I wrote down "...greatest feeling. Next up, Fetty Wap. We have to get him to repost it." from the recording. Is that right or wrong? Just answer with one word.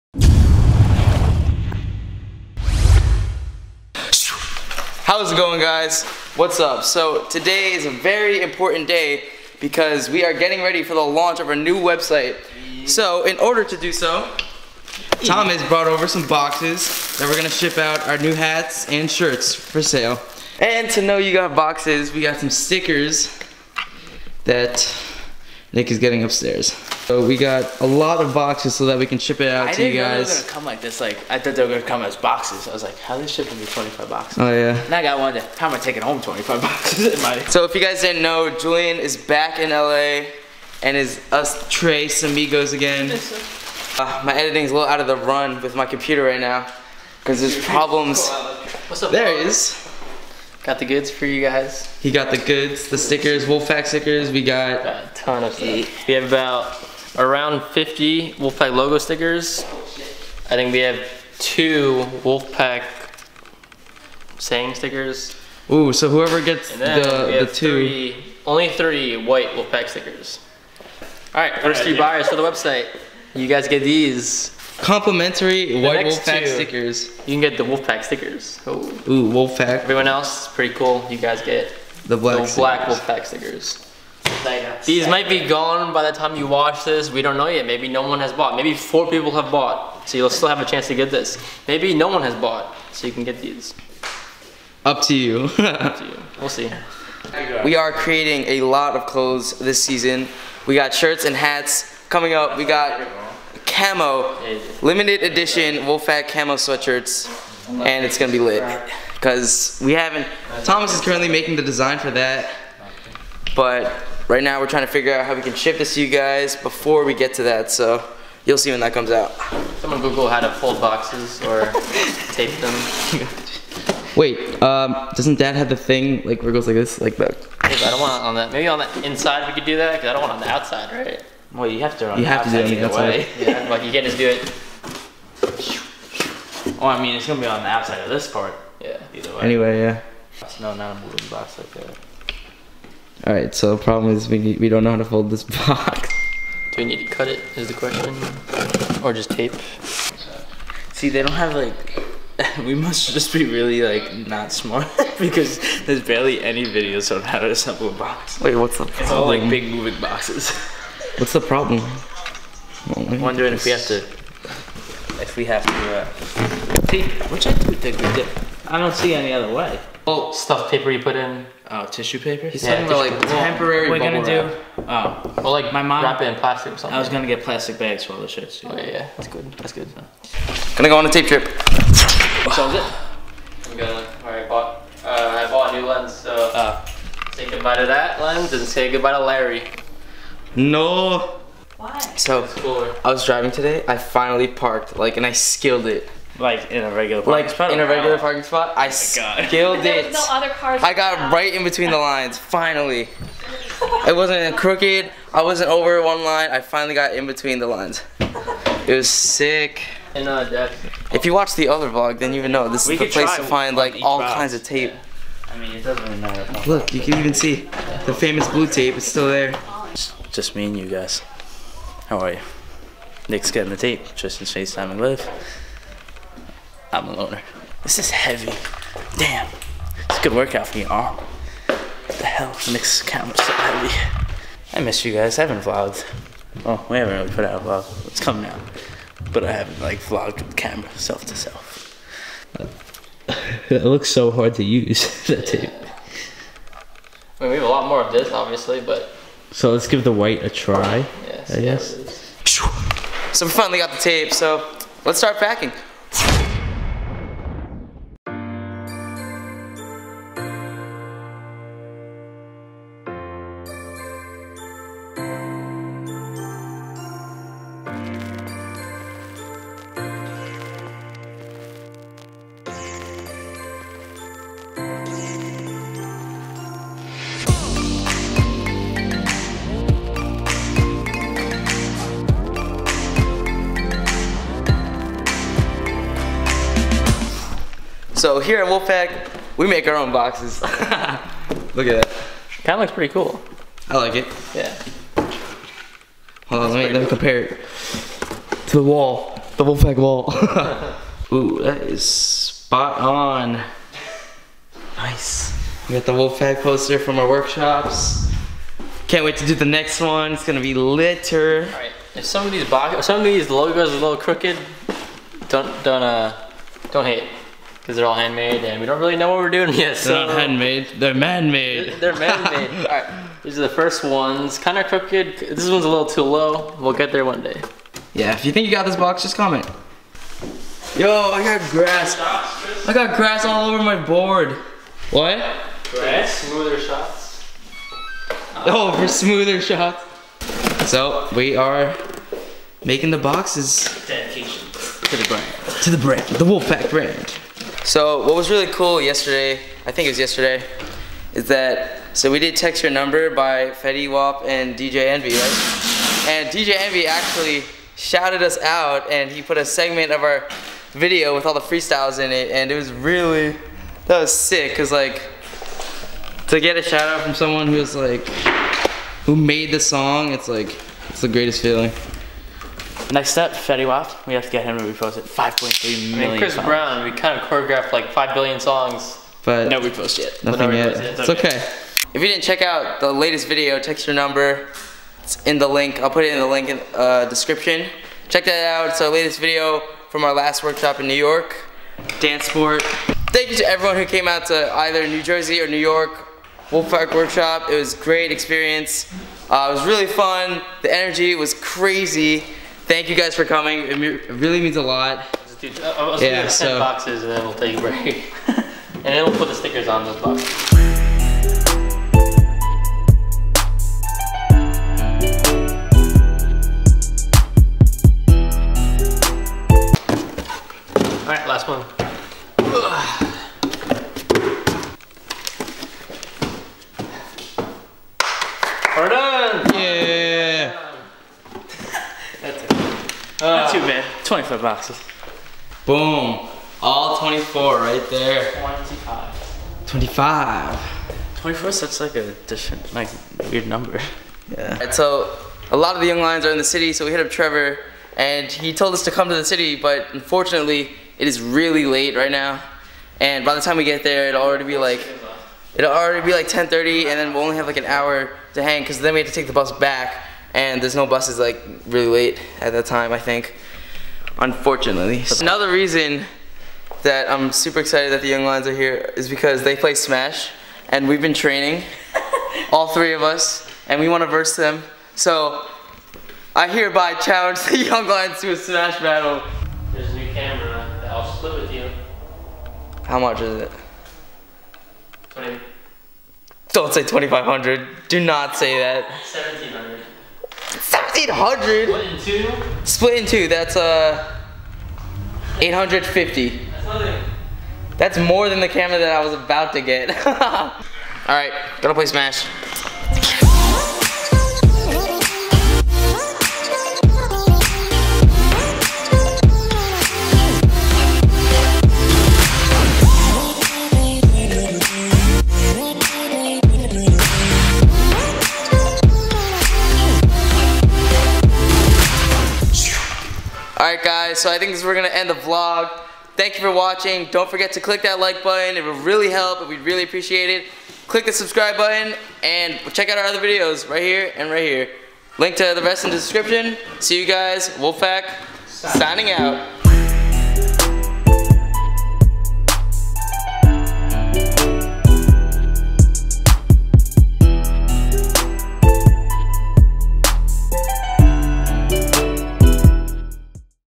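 right.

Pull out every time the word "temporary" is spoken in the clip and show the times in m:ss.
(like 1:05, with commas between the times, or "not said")
2:53.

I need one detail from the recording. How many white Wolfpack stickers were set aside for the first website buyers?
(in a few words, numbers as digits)
3.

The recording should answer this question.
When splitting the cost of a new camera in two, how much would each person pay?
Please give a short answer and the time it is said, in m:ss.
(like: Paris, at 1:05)
850, at 8:15.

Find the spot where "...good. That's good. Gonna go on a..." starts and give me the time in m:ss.
2:59.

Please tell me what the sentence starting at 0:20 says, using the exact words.
And to know you got boxes, we got some stickers that Nick is getting upstairs.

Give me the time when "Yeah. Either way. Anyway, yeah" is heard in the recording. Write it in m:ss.
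2:18.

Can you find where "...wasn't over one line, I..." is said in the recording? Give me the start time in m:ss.
3:25.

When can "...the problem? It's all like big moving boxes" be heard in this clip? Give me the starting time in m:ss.
2:38.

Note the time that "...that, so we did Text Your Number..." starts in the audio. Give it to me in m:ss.
5:51.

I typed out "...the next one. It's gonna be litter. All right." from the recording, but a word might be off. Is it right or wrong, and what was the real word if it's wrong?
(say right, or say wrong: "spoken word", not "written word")
right.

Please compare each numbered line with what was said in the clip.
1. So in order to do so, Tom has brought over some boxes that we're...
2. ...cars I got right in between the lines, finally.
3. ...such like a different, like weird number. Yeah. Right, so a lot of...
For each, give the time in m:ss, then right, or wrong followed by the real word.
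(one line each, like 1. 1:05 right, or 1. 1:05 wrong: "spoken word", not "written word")
1. 0:12 right
2. 3:20 right
3. 7:21 right.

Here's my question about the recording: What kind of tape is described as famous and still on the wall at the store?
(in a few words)
Blue tape.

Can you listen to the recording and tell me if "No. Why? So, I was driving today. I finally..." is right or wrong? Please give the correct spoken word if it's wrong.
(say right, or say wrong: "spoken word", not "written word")
right.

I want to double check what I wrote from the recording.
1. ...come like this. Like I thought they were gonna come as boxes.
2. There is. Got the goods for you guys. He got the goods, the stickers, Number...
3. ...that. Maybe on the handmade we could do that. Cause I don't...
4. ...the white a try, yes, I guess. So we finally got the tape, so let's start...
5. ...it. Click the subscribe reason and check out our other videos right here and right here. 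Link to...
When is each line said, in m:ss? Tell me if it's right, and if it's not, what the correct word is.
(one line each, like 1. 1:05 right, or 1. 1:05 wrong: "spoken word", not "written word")
1. 0:30 right
2. 0:49 wrong: "Wolfpack", not "Number"
3. 2:08 wrong: "inside", not "handmade"
4. 4:10 right
5. 8:50 wrong: "button", not "reason".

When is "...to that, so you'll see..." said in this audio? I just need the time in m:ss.
1:57.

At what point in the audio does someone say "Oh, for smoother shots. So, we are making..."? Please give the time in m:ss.
5:38.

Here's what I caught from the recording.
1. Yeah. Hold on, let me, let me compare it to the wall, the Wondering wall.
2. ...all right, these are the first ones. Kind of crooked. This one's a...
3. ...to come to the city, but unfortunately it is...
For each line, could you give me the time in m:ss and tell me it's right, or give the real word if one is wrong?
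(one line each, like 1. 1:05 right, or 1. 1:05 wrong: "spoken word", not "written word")
1. 4:54 wrong: "Wolfpack", not "Wondering"
2. 5:22 right
3. 7:29 right.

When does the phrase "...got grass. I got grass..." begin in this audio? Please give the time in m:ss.
5:31.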